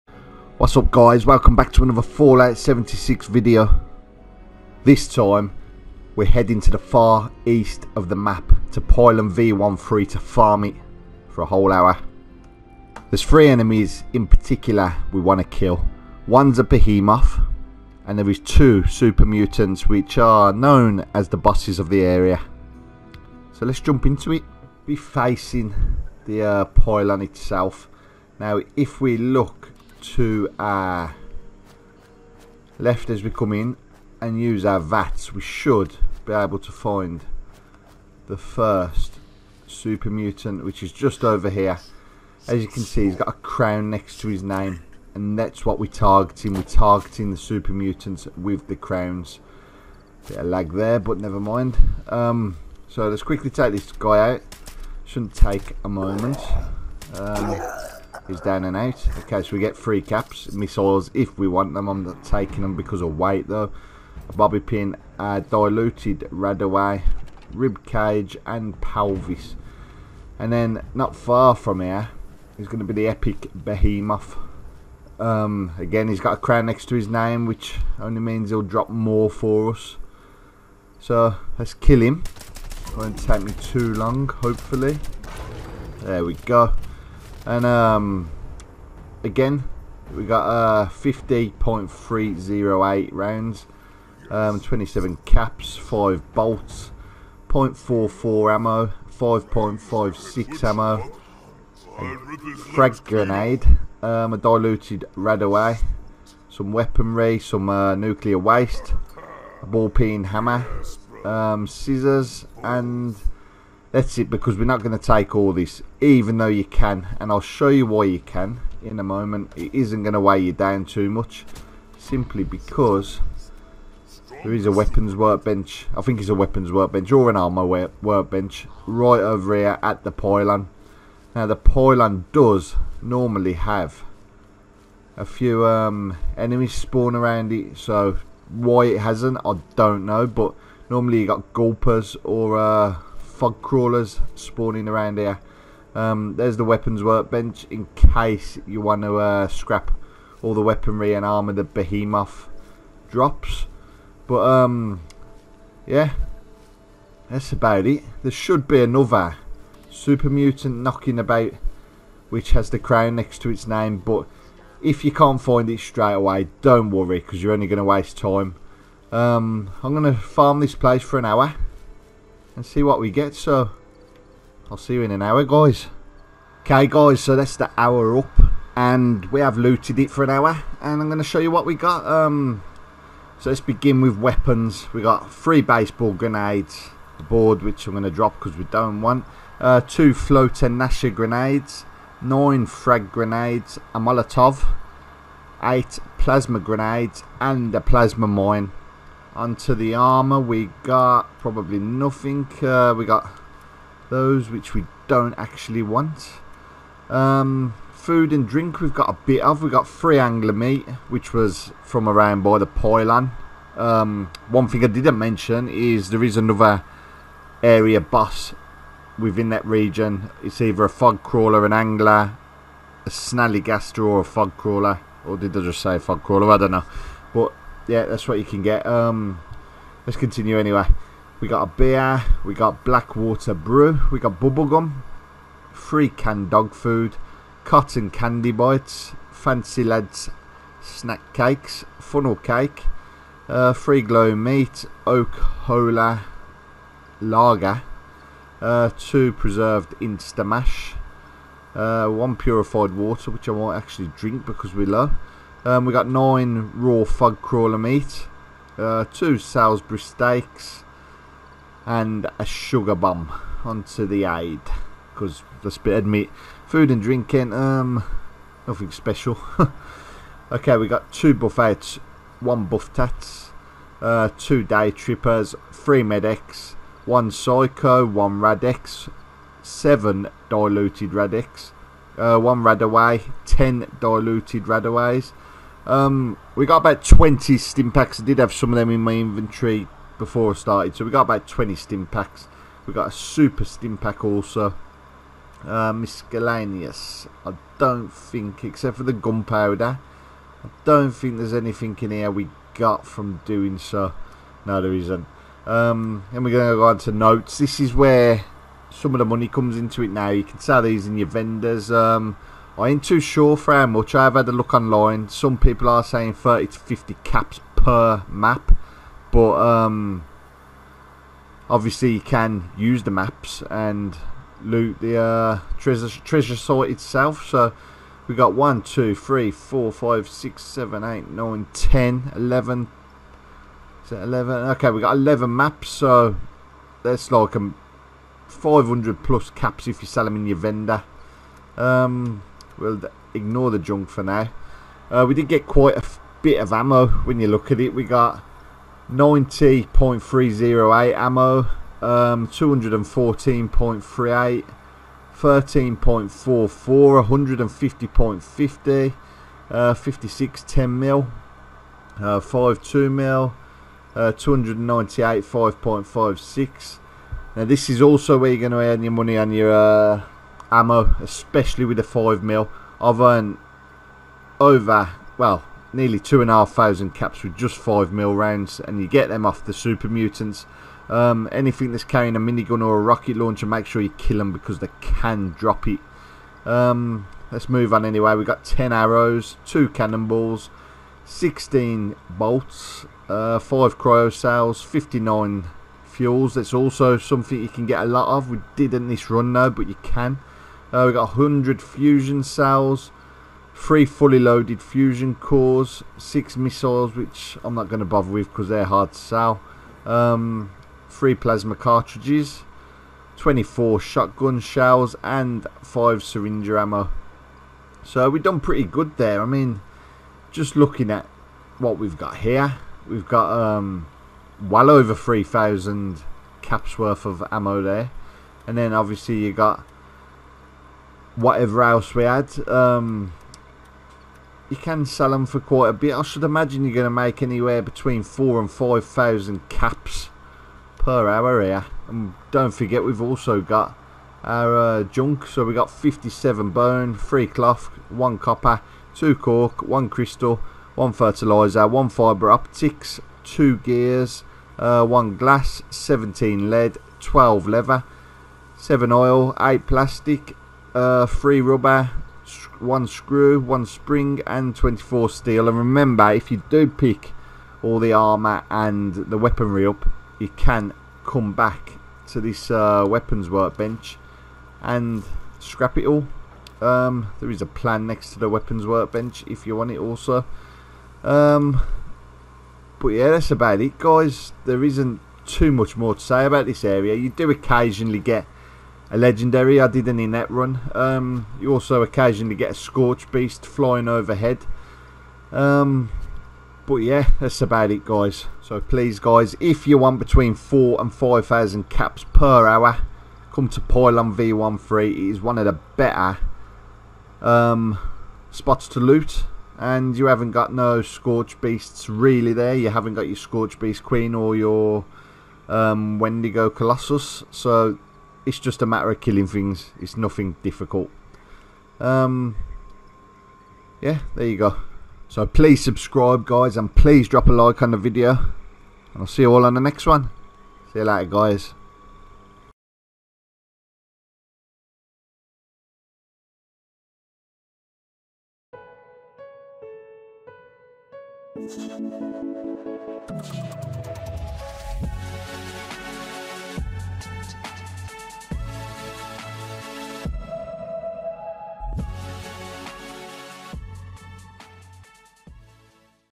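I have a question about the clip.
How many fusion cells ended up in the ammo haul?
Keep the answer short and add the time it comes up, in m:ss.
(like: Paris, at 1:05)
100, at 6:41.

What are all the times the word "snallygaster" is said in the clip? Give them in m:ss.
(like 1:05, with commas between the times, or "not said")
3:43.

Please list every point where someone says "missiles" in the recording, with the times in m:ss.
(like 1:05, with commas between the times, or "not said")
1:00, 6:46.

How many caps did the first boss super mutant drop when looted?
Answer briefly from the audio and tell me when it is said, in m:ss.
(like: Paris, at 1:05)
3, at 0:59.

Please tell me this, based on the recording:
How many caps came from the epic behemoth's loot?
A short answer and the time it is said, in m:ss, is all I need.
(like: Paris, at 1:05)
27, at 1:34.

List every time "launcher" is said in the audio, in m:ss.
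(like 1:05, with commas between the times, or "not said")
6:23.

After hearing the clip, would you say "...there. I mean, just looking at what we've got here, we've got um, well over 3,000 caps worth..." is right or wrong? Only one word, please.
right.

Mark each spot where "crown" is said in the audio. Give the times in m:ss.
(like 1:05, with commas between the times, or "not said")
0:43, 0:48, 1:16, 2:42.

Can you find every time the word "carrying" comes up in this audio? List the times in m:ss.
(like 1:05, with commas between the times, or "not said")
6:22.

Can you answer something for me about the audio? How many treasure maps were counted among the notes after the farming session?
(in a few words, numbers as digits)
11.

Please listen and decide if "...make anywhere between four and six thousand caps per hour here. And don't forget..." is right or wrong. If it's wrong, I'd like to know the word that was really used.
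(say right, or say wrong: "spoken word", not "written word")
wrong: "five", not "six".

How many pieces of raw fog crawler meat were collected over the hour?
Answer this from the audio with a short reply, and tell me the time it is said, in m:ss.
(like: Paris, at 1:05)
9, at 4:16.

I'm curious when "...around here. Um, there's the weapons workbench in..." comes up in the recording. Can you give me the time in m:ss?
2:24.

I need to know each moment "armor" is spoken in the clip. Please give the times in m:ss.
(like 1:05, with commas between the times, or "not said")
2:07, 2:31, 3:19, 7:48.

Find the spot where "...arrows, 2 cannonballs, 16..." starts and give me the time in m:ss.
6:28.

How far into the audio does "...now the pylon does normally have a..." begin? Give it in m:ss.
2:11.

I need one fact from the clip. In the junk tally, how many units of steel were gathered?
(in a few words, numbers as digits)
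24.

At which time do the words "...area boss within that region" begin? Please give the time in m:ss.
3:37.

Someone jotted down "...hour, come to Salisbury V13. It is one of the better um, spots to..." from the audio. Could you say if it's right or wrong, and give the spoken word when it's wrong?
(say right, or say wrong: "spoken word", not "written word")
wrong: "Pylon", not "Salisbury".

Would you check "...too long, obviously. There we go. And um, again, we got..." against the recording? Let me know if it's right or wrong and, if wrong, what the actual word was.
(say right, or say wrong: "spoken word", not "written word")
wrong: "hopefully", not "obviously".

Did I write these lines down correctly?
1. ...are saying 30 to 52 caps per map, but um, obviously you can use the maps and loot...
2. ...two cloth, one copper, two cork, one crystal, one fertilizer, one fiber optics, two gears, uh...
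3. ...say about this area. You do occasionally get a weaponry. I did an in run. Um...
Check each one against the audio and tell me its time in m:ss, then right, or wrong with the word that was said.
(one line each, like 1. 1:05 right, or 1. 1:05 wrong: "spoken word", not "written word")
1. 5:15 wrong: "50", not "52"
2. 7:27 wrong: "three", not "two"
3. 8:06 wrong: "legendary", not "weaponry".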